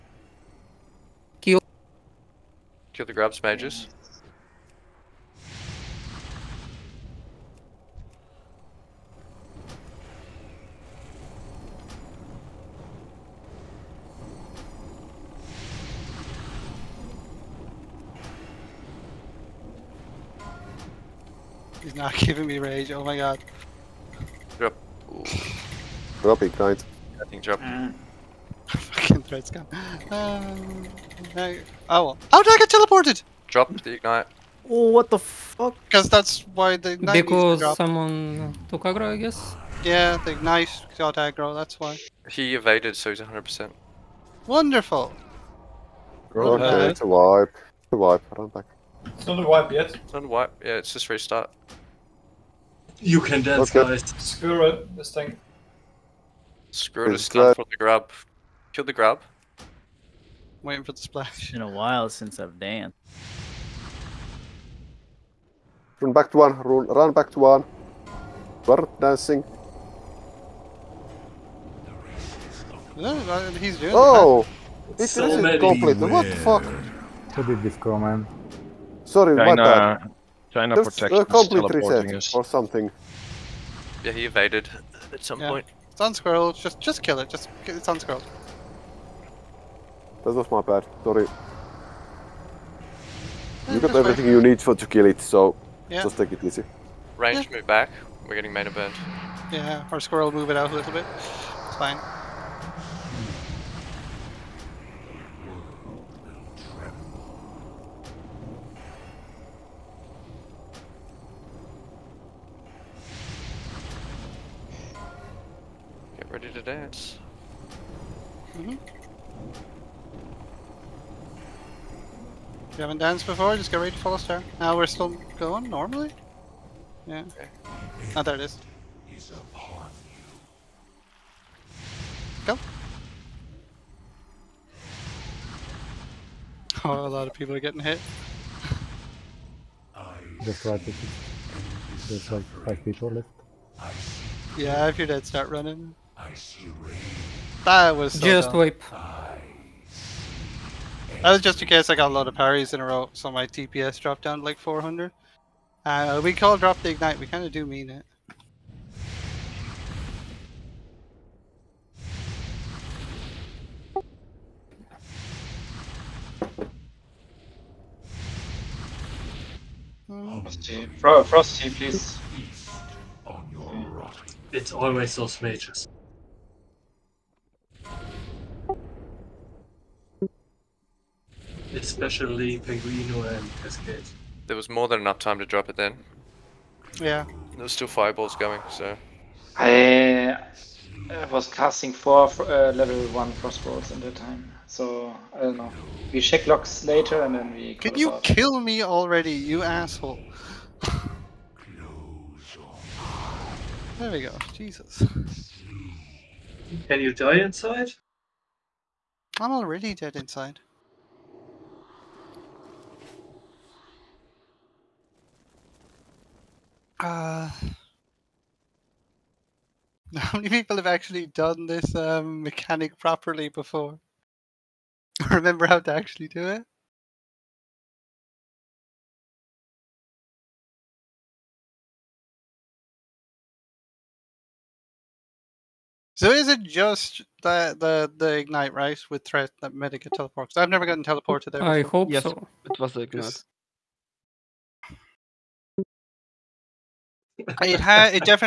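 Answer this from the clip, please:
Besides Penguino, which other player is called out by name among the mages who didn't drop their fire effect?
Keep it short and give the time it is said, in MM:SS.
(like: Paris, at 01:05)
Cascade, at 03:03.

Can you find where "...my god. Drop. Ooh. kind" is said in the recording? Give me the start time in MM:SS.
00:23.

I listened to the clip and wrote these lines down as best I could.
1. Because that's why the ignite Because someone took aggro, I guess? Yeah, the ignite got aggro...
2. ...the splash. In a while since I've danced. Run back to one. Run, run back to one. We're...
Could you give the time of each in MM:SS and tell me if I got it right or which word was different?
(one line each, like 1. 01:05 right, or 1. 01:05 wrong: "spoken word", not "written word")
1. 00:35 right
2. 01:00 right.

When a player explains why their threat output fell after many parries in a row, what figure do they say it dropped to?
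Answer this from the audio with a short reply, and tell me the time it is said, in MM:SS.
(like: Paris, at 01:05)
400, at 02:34.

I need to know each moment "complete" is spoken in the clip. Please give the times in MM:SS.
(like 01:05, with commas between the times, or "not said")
01:15, 01:21.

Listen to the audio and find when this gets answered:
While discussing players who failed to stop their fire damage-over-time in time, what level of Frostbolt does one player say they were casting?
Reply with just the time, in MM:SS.
03:12.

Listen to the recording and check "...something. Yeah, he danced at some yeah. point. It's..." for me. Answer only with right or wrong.
wrong.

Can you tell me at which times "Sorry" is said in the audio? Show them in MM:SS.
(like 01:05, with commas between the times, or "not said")
01:19, 01:31.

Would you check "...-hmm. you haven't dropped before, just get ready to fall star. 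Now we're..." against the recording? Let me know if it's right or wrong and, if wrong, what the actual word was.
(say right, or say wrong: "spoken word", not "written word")
wrong: "danced", not "dropped".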